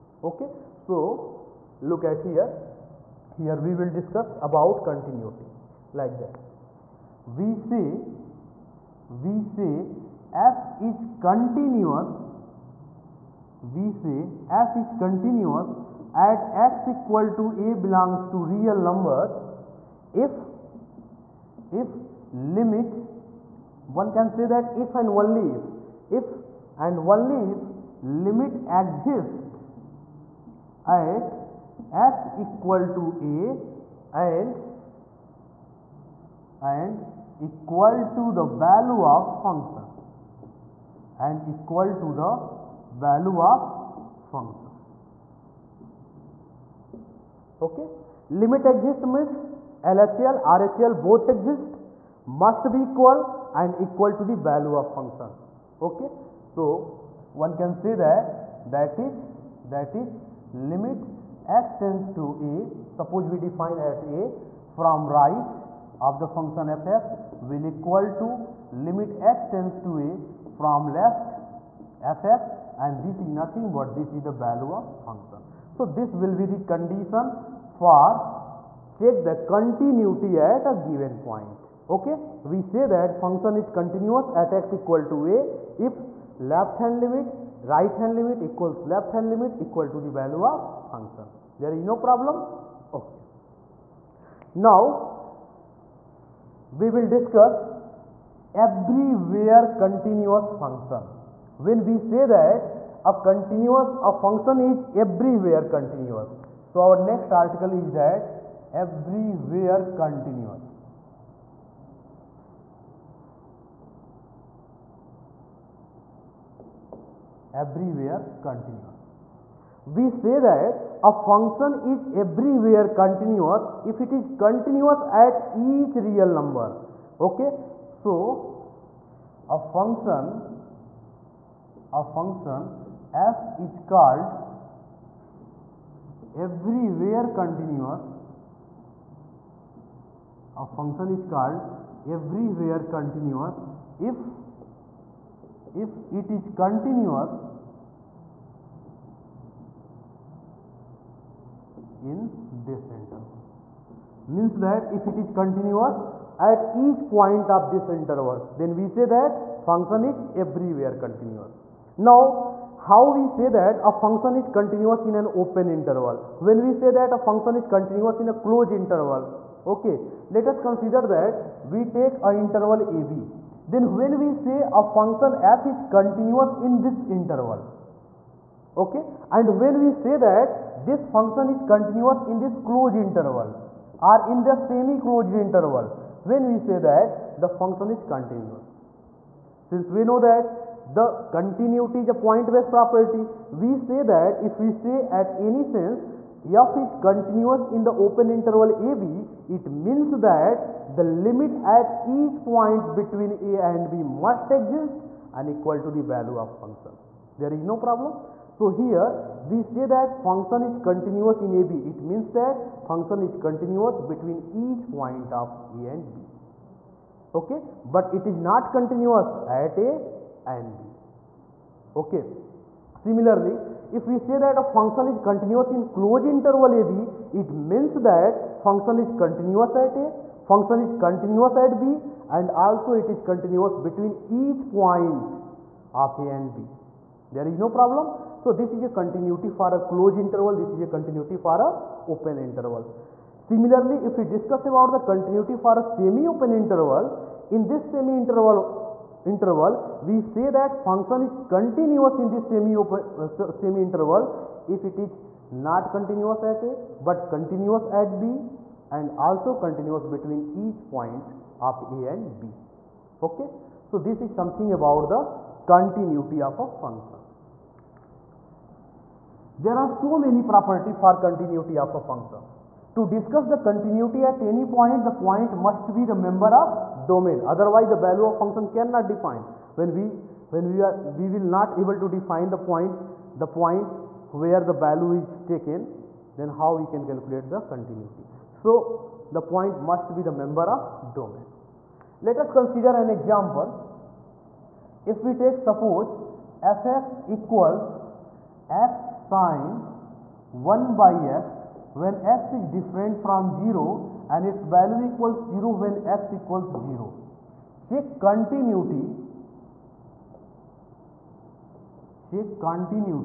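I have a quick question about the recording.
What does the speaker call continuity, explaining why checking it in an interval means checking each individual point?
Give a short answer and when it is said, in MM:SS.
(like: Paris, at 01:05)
A point based property, at 03:12.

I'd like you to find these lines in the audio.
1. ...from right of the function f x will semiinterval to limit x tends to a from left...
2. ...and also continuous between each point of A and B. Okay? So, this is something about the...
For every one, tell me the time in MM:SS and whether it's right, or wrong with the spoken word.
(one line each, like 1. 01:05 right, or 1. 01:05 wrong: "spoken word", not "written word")
1. 01:04 wrong: "equal", not "semiinterval"
2. 04:18 right.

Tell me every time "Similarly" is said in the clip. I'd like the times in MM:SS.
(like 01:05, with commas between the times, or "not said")
03:42, 04:03.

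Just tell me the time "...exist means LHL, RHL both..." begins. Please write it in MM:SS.
00:48.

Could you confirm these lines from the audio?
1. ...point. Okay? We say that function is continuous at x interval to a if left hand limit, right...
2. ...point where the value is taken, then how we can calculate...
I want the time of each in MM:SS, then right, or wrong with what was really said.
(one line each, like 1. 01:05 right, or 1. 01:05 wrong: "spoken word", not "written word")
1. 01:21 wrong: "equal", not "interval"
2. 04:43 right.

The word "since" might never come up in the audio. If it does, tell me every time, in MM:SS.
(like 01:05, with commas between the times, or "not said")
03:09.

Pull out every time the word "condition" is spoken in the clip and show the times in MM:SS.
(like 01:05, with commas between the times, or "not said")
01:16.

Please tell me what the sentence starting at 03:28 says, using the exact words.
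So here we say that function is continuous in AB.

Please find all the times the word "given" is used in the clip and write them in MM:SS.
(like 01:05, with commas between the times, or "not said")
01:20.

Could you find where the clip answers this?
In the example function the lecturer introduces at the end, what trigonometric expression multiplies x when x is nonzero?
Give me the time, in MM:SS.
04:59.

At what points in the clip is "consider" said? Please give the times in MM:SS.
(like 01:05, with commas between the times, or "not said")
02:50, 04:52.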